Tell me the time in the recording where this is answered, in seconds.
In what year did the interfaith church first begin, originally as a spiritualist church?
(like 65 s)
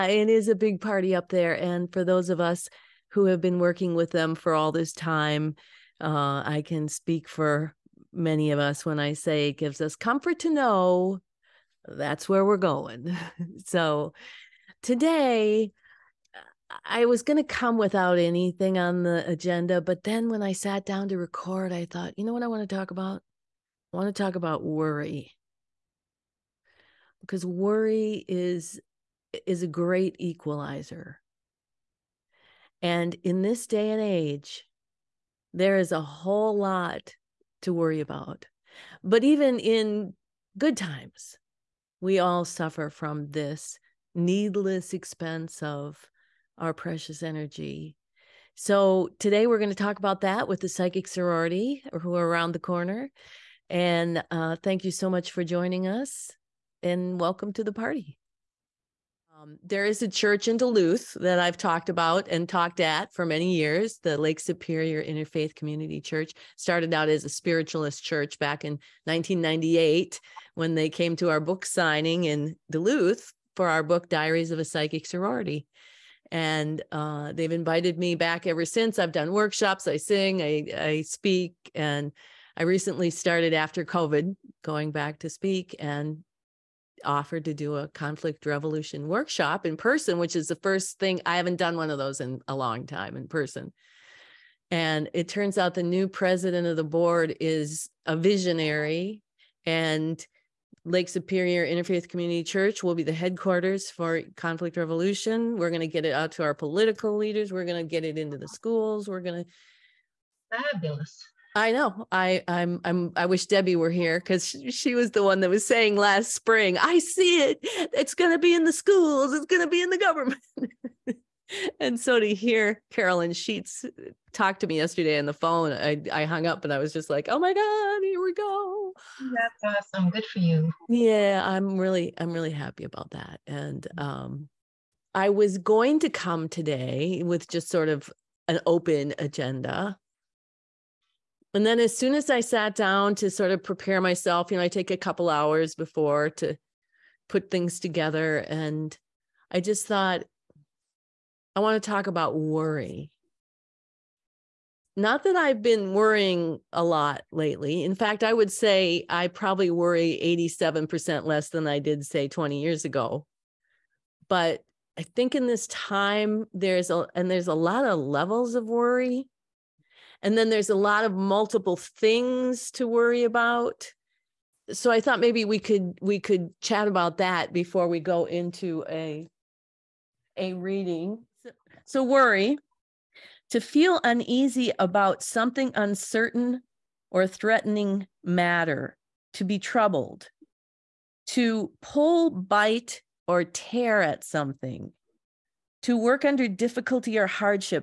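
69 s.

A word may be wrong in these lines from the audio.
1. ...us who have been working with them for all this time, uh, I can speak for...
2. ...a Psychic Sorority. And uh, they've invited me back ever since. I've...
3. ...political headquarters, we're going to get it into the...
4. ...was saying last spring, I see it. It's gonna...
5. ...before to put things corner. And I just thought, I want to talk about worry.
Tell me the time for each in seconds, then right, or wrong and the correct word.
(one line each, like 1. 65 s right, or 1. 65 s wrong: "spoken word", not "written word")
1. 2 s right
2. 74 s right
3. 106 s wrong: "leaders", not "headquarters"
4. 115 s right
5. 145 s wrong: "together", not "corner".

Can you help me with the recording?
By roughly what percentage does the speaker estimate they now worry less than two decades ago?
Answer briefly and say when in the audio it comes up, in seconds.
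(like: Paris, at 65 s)
87%, at 160 s.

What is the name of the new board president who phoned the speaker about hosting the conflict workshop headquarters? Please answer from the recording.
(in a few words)
Carolyn Sheets.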